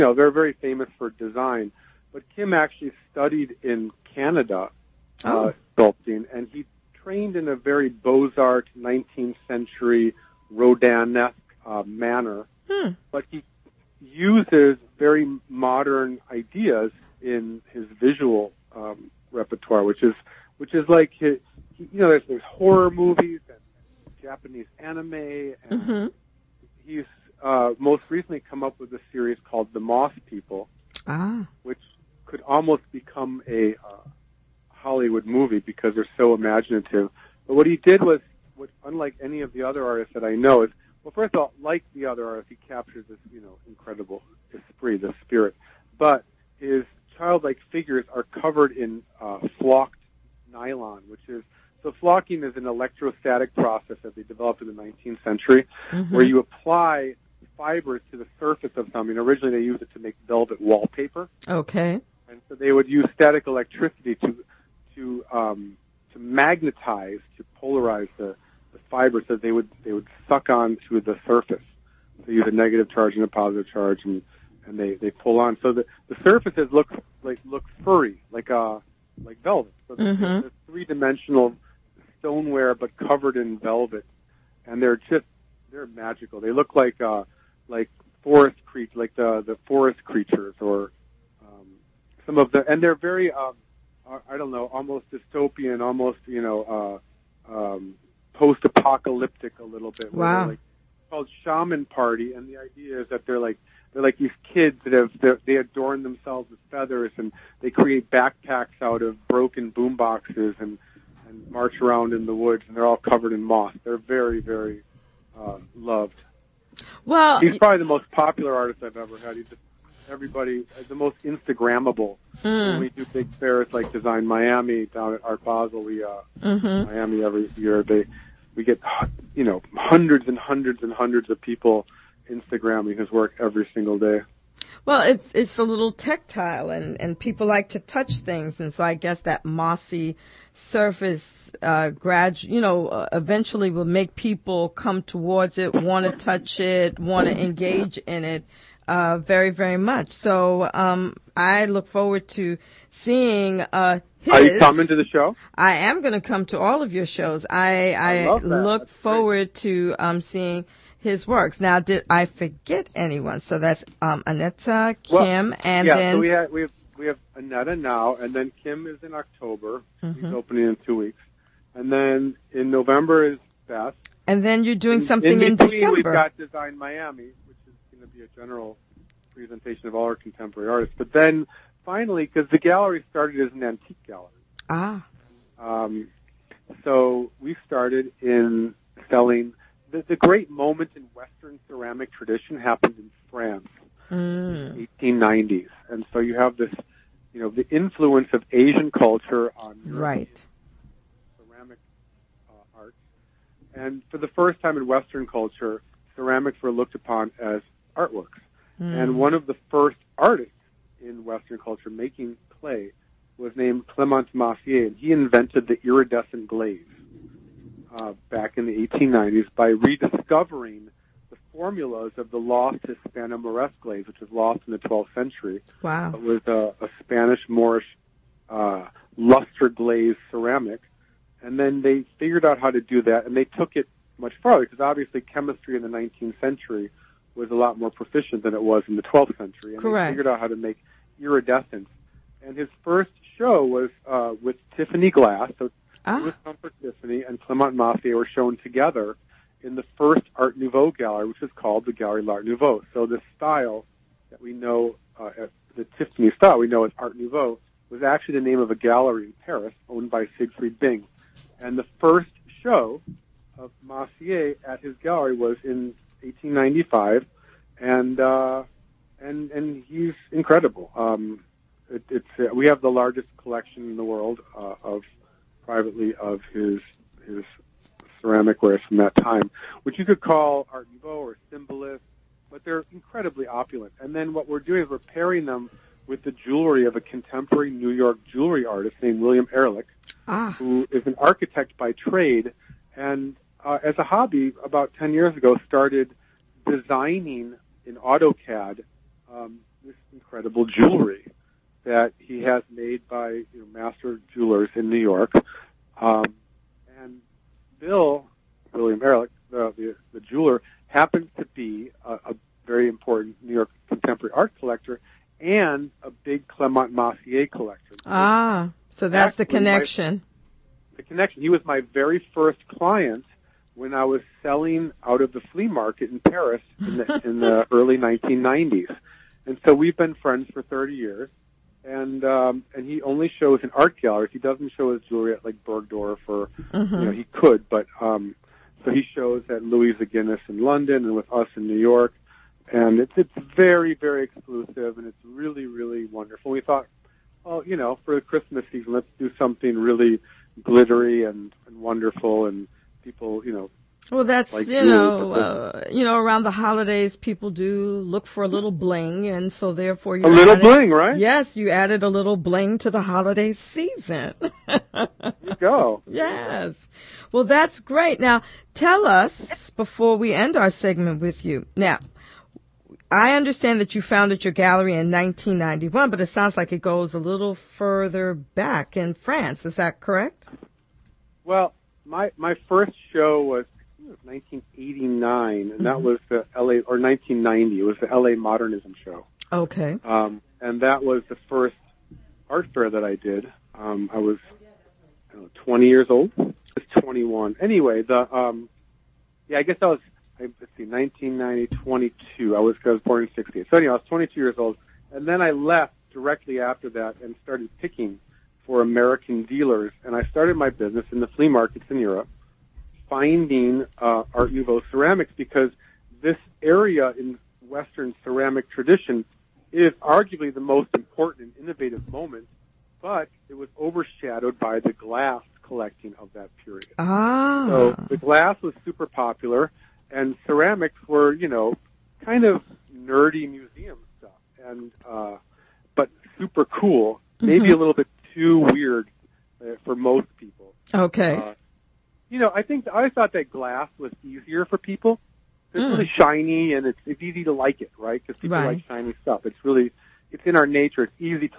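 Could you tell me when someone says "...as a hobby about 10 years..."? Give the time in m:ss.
4:53.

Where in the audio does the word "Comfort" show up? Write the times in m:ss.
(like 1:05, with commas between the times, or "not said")
4:06.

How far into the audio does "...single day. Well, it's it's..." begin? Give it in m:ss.
2:13.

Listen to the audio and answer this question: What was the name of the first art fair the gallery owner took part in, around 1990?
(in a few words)
LA Modernism show.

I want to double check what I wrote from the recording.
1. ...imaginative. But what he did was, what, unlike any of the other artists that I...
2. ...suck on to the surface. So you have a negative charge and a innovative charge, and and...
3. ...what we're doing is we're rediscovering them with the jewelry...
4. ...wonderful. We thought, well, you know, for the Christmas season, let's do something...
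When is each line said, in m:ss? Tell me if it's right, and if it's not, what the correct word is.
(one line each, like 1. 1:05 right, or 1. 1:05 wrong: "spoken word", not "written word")
1. 0:36 right
2. 1:10 wrong: "positive", not "innovative"
3. 4:44 wrong: "pairing", not "rediscovering"
4. 5:46 right.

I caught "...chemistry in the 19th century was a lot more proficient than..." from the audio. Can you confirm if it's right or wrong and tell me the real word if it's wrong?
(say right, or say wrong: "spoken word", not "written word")
right.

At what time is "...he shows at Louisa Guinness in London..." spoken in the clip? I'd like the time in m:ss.
5:38.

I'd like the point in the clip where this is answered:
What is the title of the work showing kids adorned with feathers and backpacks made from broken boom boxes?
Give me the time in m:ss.
1:41.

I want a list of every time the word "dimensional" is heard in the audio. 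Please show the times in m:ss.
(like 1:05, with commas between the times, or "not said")
1:20.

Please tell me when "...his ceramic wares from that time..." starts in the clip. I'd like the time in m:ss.
4:37.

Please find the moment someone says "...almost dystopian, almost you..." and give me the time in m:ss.
1:34.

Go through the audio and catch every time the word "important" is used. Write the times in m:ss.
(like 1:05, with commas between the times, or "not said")
5:12, 7:00.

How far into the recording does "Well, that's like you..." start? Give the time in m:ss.
5:54.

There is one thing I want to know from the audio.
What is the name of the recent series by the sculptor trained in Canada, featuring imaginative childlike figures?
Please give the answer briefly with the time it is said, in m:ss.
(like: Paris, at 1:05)
The Moss People, at 0:29.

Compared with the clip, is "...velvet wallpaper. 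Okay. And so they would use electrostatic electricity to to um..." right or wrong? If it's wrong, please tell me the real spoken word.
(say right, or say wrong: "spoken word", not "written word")
wrong: "static", not "electrostatic".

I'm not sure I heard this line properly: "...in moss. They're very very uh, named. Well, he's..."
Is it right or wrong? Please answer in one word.
wrong.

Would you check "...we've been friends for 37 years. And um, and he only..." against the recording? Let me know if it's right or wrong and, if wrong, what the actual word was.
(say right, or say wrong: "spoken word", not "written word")
wrong: "30", not "37".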